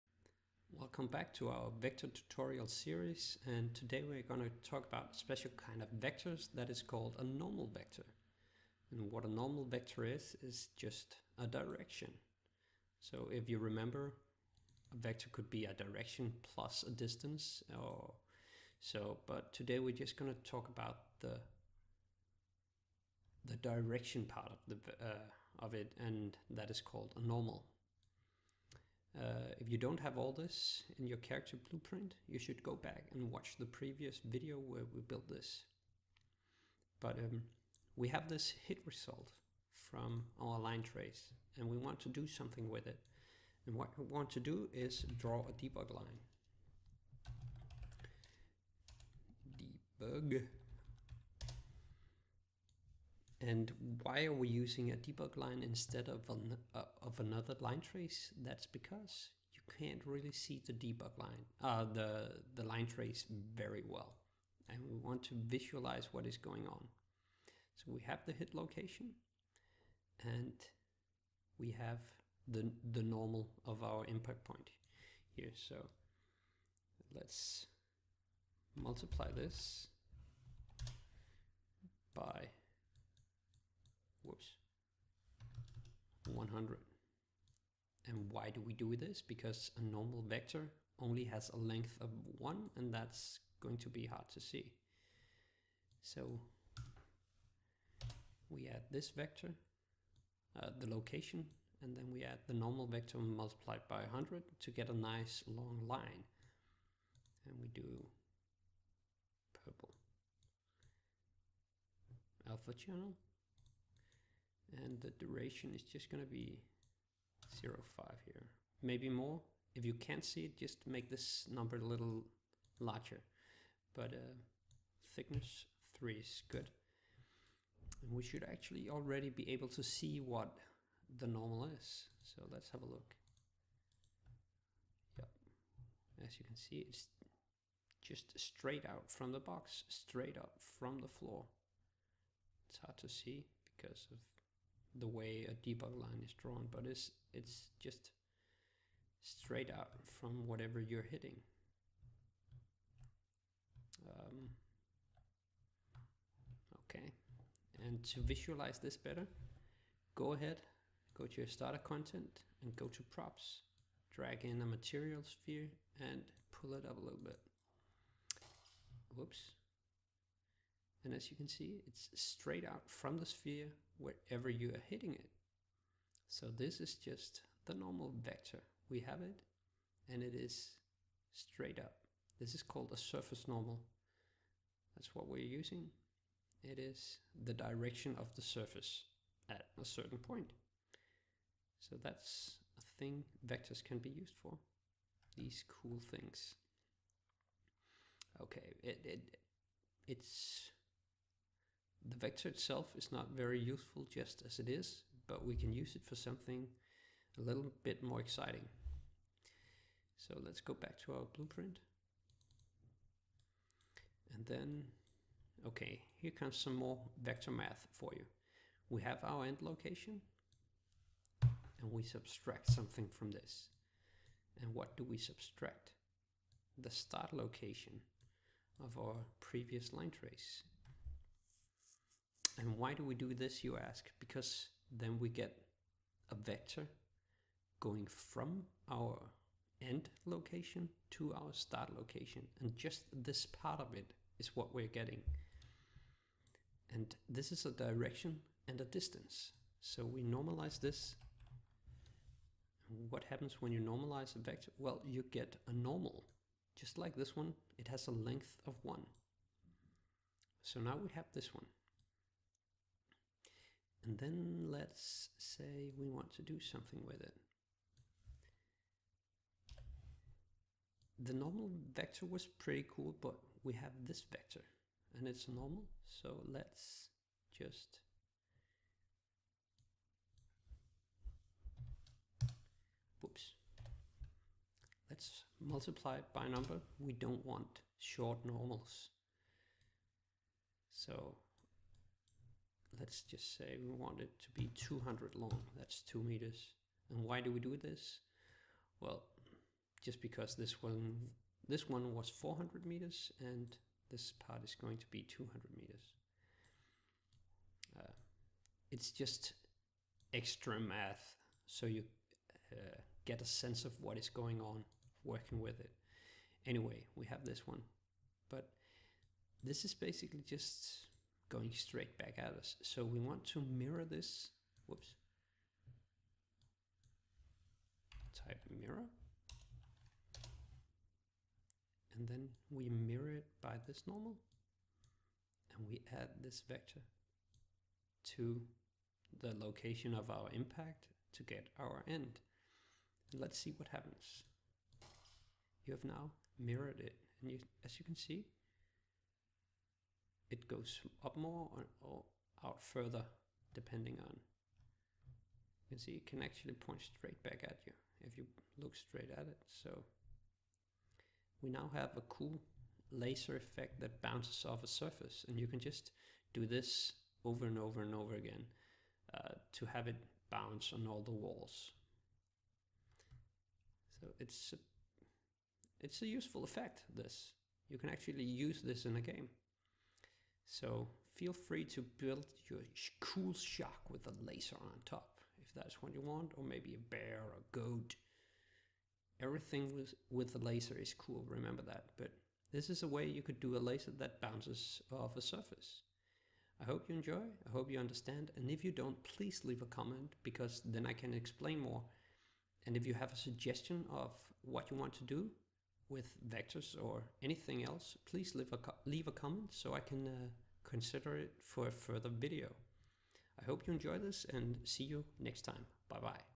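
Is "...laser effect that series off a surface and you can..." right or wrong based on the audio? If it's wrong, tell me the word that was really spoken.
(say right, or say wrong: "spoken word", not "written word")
wrong: "bounces", not "series".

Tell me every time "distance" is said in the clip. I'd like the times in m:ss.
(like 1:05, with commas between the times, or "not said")
0:16, 4:08.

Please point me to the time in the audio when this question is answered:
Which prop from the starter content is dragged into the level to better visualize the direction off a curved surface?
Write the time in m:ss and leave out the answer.
2:44.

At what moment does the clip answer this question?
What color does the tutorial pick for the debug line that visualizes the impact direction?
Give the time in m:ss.
1:49.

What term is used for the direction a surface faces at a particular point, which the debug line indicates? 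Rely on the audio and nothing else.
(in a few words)
Surface normal.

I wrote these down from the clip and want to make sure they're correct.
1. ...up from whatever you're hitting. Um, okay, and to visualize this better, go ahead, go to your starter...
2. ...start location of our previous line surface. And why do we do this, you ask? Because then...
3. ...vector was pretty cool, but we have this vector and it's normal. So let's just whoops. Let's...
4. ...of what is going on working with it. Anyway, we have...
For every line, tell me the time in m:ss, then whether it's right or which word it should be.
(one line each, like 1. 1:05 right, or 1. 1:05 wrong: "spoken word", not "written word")
1. 2:29 right
2. 3:46 wrong: "trace", not "surface"
3. 4:31 right
4. 5:13 right.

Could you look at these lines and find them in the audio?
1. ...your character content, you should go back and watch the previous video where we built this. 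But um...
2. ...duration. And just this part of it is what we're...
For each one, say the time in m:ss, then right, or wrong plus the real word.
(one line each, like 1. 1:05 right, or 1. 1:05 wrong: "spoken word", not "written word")
1. 0:31 wrong: "blueprint", not "content"
2. 4:01 wrong: "location", not "duration".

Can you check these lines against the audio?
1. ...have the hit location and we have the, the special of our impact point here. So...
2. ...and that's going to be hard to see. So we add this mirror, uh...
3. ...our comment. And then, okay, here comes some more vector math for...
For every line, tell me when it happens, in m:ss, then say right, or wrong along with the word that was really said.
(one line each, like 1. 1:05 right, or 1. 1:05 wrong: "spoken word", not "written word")
1. 1:08 wrong: "normal", not "special"
2. 1:32 wrong: "vector", not "mirror"
3. 3:31 wrong: "blueprint", not "comment".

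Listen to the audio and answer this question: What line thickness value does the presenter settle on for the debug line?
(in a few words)
3.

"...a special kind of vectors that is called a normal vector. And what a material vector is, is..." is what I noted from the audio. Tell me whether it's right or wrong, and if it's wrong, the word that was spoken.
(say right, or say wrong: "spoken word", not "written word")
wrong: "normal", not "material".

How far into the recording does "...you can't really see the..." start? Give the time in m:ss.
0:59.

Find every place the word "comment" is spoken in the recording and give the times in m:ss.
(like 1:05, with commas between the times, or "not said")
6:39, 6:49.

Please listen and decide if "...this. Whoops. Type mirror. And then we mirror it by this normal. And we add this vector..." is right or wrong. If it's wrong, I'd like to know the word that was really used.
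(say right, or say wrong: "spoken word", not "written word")
right.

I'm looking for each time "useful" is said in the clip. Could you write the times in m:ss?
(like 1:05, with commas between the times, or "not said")
3:23, 6:16.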